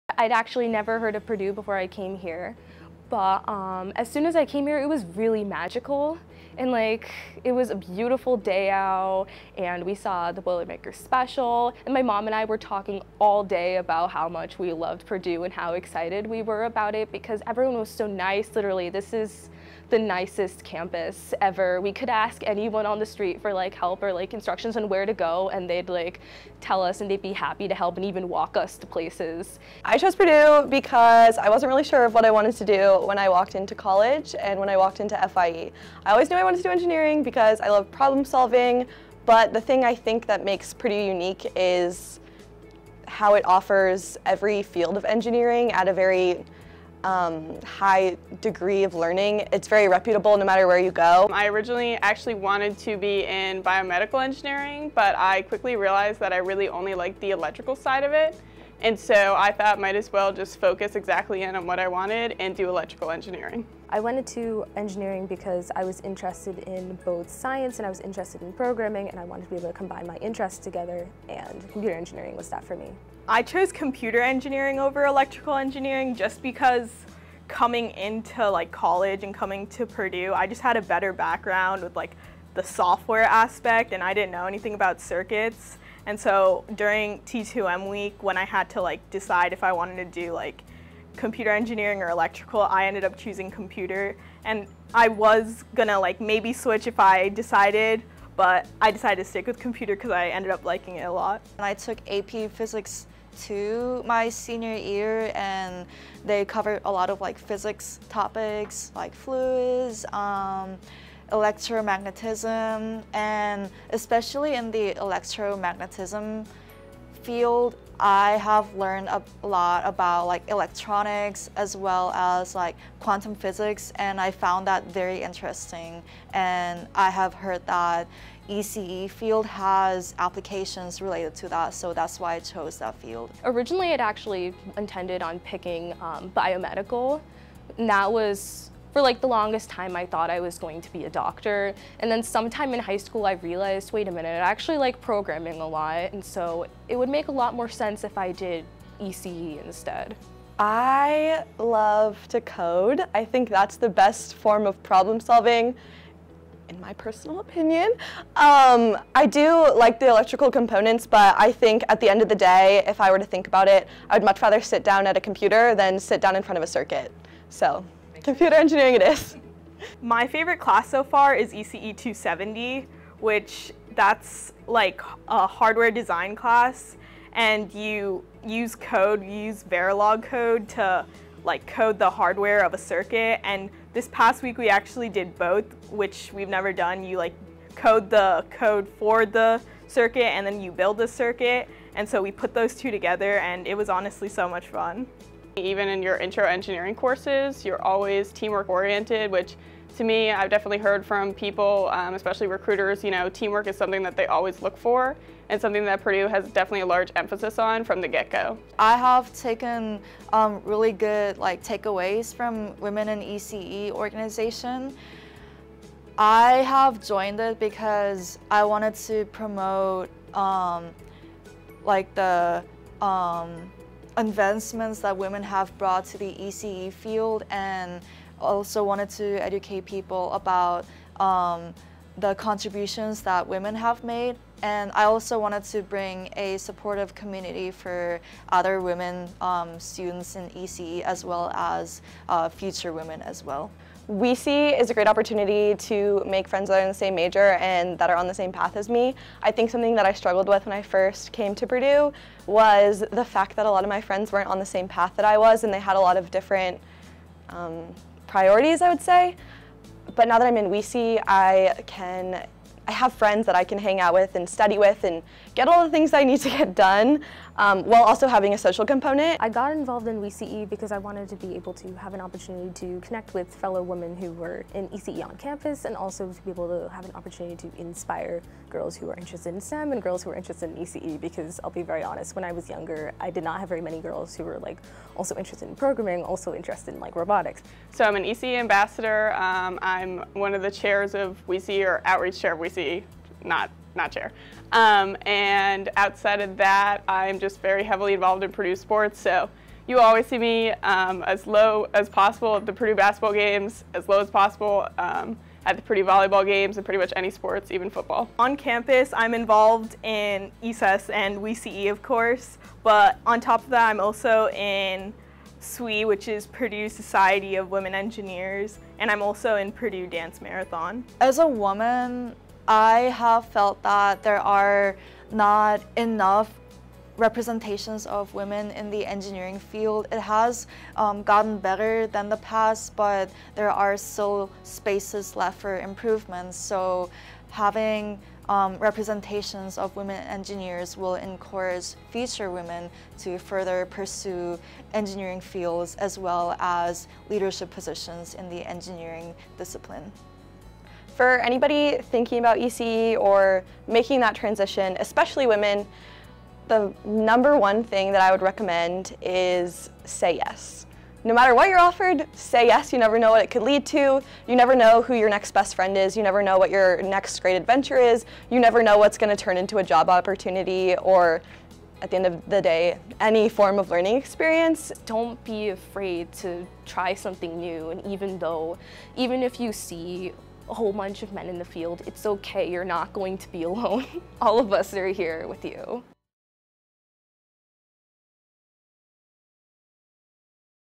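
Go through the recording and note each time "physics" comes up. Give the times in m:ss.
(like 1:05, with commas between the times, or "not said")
1:42, 1:47, 2:03.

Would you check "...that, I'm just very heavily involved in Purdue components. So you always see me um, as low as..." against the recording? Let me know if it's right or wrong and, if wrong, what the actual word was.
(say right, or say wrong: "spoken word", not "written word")
wrong: "sports", not "components".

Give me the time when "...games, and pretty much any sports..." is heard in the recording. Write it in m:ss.
5:06.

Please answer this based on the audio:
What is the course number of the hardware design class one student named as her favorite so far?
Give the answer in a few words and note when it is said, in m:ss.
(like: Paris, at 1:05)
ECE 270, at 2:51.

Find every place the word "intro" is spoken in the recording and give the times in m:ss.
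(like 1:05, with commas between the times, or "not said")
3:16.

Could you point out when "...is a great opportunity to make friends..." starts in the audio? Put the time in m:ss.
4:04.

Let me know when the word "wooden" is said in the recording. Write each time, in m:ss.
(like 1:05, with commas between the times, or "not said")
not said.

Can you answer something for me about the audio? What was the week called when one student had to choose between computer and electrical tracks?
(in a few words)
T2M week.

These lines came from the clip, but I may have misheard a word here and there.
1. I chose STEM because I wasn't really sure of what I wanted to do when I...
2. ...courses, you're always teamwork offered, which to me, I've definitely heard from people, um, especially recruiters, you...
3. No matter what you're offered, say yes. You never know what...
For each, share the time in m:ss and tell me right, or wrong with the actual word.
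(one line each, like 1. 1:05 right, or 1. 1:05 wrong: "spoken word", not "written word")
1. 0:29 wrong: "Purdue", not "STEM"
2. 3:16 wrong: "oriented", not "offered"
3. 6:01 right.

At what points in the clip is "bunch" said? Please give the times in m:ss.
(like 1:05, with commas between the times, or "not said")
6:20.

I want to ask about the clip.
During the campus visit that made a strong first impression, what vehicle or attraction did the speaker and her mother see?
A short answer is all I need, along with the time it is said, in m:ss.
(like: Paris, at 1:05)
Boilermaker Special, at 0:10.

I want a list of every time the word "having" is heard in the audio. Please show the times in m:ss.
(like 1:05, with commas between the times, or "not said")
4:28, 5:37.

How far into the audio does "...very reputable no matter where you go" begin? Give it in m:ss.
0:49.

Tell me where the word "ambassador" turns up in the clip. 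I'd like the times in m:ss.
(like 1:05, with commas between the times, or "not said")
4:48.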